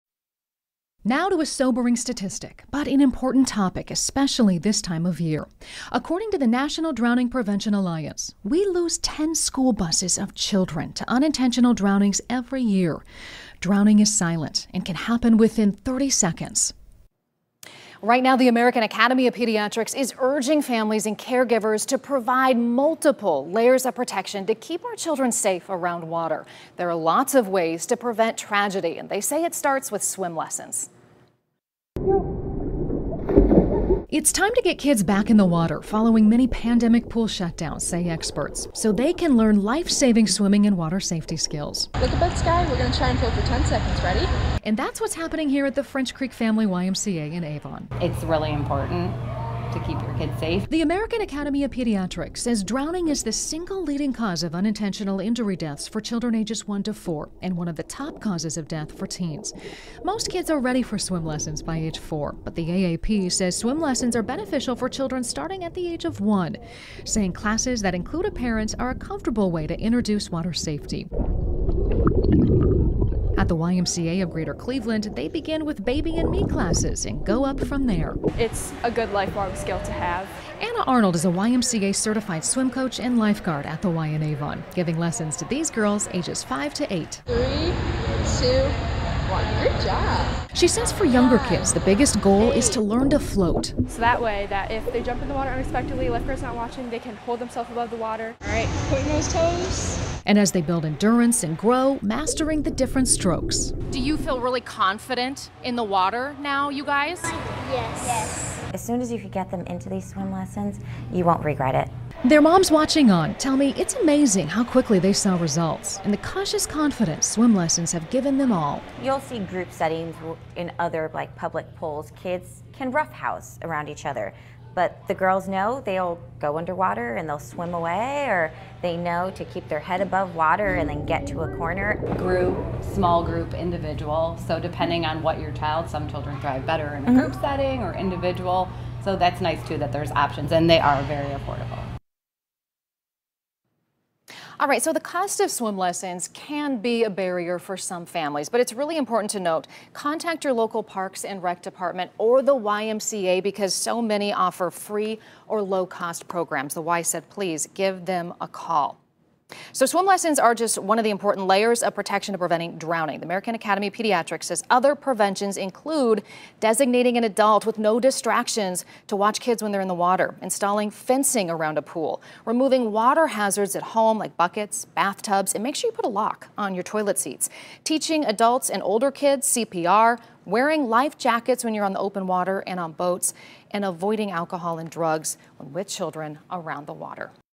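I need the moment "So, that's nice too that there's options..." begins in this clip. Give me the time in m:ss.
2:19.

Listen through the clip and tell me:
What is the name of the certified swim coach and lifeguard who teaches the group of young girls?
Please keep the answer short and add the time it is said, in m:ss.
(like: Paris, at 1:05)
Anna Arnold, at 1:20.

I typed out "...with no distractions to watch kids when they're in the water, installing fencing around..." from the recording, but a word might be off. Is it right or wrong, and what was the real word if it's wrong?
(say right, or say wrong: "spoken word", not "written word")
right.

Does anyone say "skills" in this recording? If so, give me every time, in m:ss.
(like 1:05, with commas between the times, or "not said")
0:41, 1:19.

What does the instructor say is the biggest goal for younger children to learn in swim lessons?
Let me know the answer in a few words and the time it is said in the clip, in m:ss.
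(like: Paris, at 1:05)
To float, at 1:32.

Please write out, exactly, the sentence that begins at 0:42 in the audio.
Look above sky, we're going to try and fill for 10 seconds.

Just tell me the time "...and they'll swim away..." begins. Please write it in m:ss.
2:07.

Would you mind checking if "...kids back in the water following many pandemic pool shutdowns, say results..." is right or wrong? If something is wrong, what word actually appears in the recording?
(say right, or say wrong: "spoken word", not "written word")
wrong: "experts", not "results".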